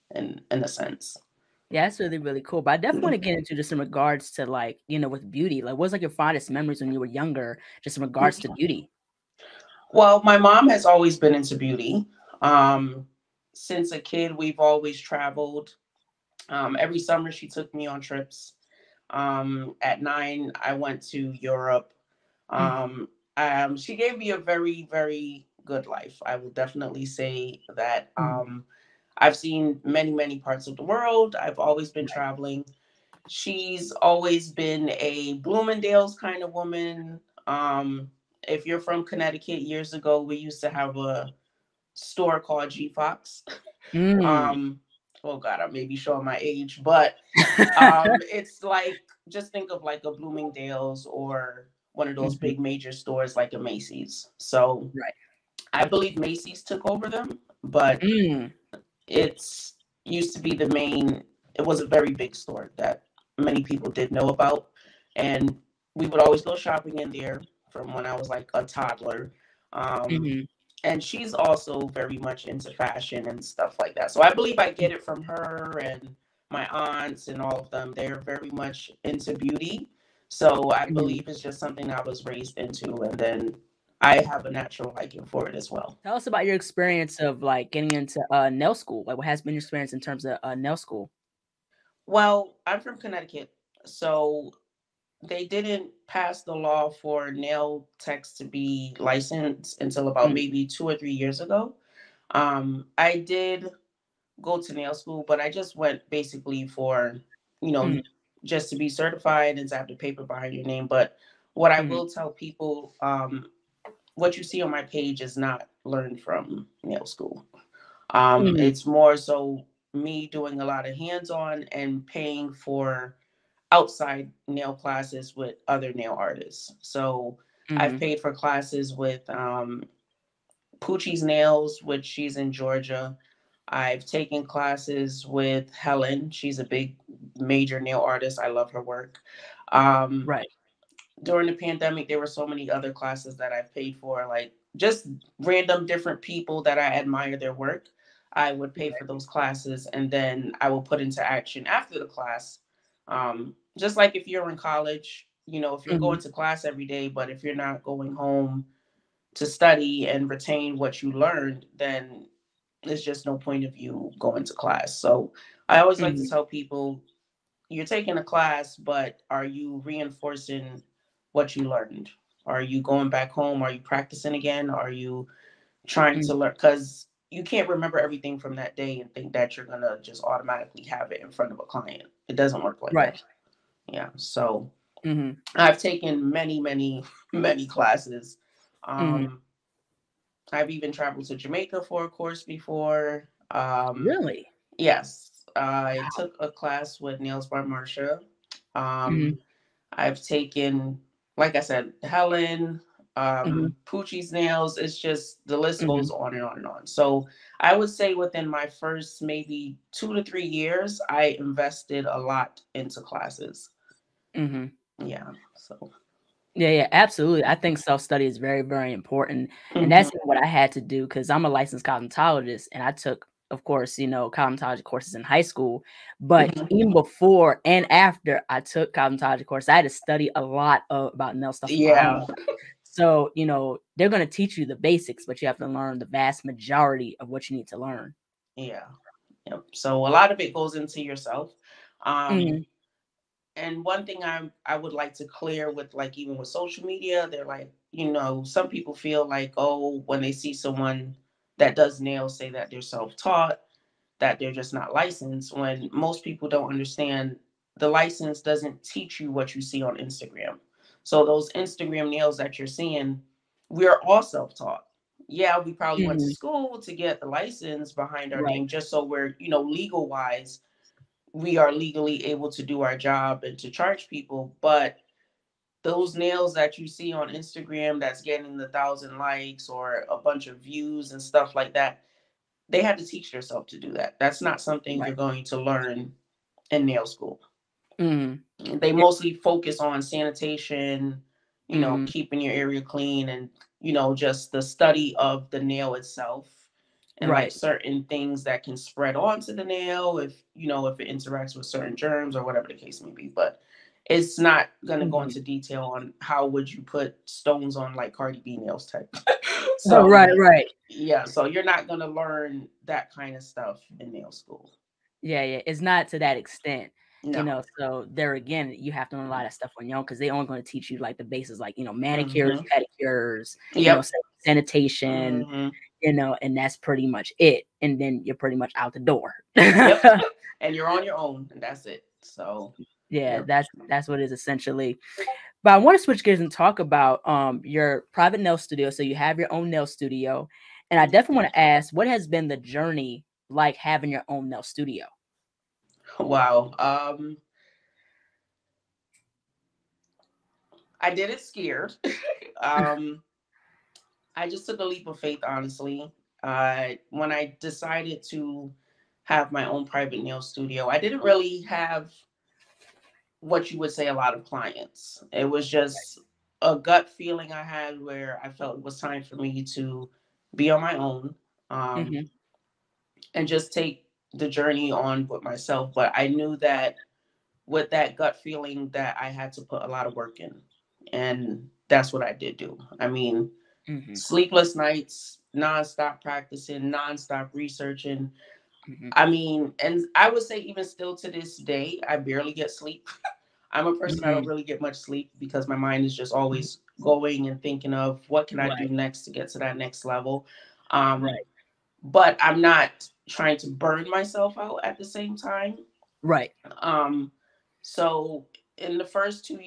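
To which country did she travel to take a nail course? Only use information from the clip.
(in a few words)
Jamaica.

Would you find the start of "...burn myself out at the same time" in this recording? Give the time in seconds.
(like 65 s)
403 s.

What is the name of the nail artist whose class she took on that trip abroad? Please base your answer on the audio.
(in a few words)
Nails by Marsha.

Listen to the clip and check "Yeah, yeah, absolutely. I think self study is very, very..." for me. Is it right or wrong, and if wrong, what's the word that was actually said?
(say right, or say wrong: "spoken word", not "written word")
right.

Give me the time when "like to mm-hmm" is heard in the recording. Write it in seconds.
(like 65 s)
166 s.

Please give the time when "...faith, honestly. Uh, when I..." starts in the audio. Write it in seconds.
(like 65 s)
355 s.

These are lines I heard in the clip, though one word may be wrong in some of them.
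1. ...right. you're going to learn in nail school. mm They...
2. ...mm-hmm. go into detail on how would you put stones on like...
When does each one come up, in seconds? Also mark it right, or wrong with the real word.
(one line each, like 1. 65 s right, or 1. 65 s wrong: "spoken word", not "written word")
1. 284 s right
2. 305 s right.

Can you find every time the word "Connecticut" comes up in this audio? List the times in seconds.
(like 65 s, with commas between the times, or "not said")
39 s, 92 s.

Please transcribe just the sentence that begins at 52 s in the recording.
big major stores like a Macy's.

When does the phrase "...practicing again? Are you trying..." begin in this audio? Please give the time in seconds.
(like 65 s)
173 s.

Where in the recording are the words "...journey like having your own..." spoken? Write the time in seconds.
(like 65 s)
342 s.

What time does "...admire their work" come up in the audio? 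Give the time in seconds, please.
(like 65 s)
146 s.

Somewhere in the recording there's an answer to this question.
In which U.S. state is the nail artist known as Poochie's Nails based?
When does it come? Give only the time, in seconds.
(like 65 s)
132 s.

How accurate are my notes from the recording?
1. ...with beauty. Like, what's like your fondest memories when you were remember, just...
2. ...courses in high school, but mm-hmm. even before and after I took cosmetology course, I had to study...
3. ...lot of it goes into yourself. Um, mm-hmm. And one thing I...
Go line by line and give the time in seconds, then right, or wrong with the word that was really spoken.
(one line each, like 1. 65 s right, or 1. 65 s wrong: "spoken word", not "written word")
1. 5 s wrong: "younger", not "remember"
2. 224 s right
3. 240 s right.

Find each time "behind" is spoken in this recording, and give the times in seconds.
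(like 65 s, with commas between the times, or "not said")
110 s, 267 s.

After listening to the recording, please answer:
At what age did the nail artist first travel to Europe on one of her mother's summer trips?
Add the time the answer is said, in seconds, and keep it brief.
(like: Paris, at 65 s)
9, at 19 s.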